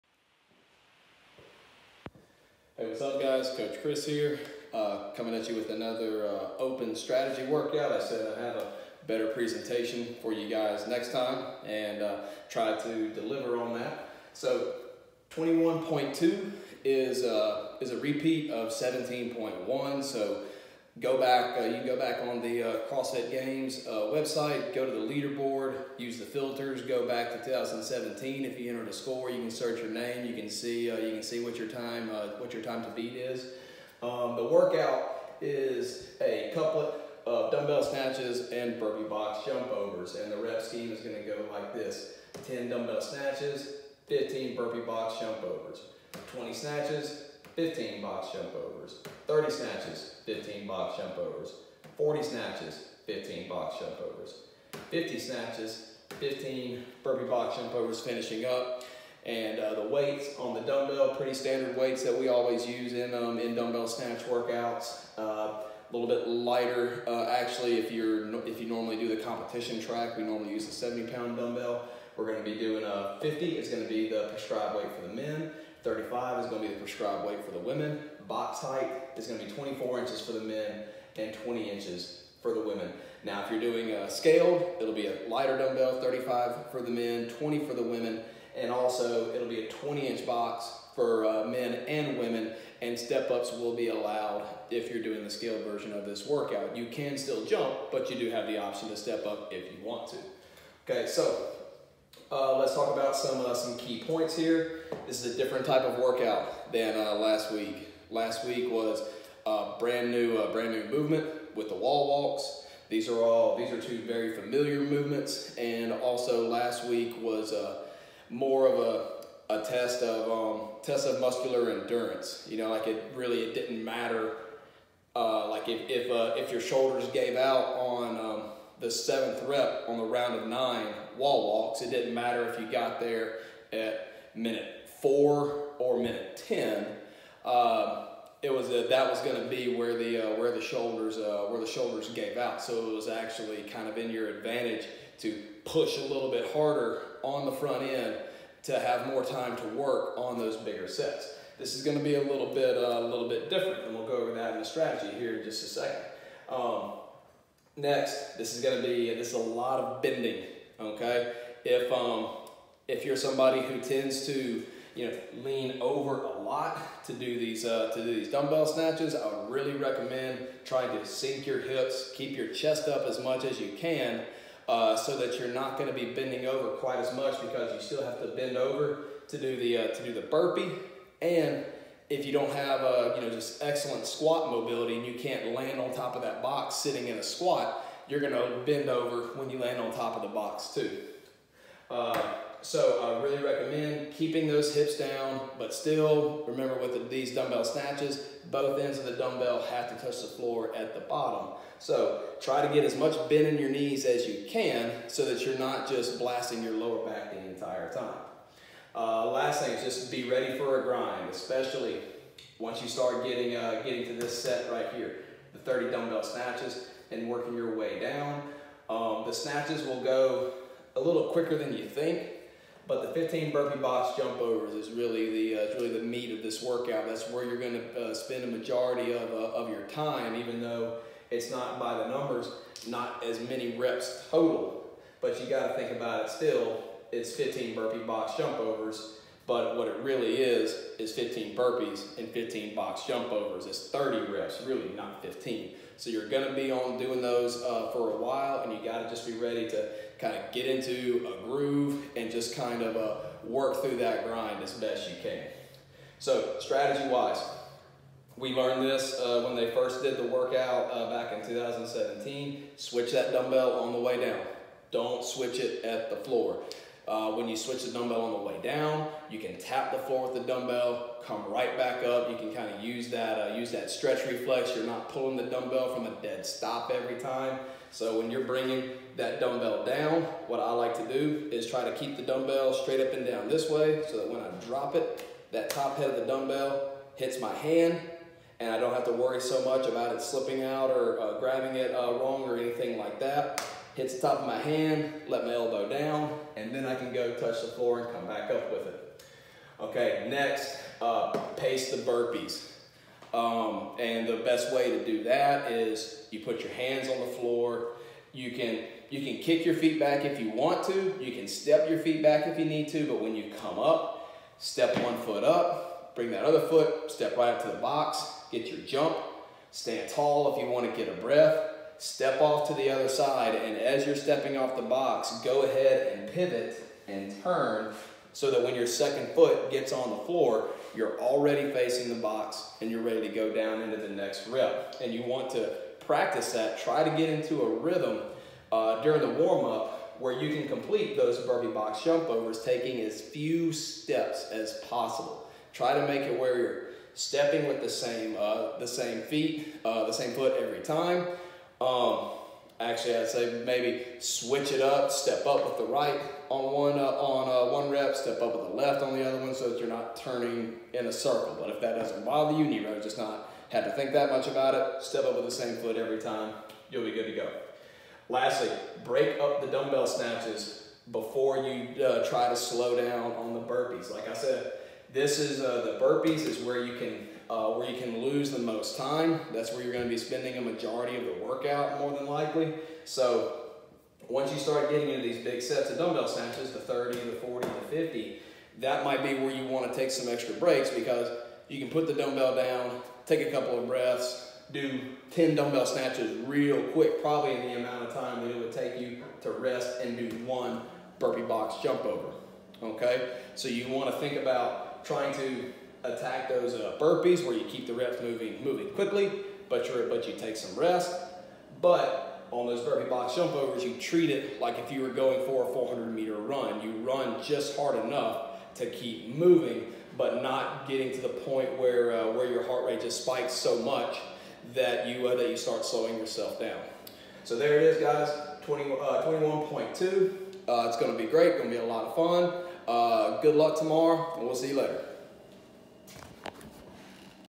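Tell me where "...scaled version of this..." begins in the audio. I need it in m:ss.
1:35.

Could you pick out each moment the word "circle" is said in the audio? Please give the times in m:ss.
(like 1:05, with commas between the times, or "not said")
6:01.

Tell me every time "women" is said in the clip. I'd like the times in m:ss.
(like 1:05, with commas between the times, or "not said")
1:17, 1:22, 1:27, 1:32.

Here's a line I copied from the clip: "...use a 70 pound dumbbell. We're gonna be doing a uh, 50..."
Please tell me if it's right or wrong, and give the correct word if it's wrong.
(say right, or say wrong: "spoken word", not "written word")
right.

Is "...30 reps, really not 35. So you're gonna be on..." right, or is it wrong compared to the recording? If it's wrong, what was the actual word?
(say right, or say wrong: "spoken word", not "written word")
wrong: "15", not "35".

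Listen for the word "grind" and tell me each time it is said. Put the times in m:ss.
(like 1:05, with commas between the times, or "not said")
3:30, 4:14.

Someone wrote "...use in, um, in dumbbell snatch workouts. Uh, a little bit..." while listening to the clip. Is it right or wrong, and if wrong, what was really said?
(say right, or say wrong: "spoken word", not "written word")
right.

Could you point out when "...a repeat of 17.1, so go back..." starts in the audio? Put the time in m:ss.
0:17.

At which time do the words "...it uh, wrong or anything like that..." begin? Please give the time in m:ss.
4:51.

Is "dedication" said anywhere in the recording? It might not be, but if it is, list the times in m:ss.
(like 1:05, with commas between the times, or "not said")
not said.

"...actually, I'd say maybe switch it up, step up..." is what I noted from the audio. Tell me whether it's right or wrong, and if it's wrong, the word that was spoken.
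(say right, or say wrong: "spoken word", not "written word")
right.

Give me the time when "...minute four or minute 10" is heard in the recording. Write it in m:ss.
2:14.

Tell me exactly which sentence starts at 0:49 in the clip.
30 snatches, 15 box jump overs.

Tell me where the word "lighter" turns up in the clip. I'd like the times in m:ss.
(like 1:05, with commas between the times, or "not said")
1:06, 1:25.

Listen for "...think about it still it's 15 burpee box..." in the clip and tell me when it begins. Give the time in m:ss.
3:55.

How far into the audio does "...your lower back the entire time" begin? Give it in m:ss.
3:26.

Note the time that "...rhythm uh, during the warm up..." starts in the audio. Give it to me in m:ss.
5:37.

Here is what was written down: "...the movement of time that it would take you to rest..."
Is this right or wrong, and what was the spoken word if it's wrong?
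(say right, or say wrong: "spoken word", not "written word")
wrong: "amount", not "movement".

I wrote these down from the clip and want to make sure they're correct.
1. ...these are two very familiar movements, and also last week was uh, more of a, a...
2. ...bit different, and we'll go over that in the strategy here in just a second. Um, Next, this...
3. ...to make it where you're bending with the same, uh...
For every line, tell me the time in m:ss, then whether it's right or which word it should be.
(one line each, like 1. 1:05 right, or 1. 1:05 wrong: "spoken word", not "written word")
1. 1:53 right
2. 2:33 right
3. 5:45 wrong: "stepping", not "bending".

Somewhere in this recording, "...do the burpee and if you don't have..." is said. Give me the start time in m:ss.
3:00.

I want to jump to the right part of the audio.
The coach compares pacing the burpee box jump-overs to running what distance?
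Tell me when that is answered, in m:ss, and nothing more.
6:55.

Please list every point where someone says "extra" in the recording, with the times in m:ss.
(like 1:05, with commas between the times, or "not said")
6:30.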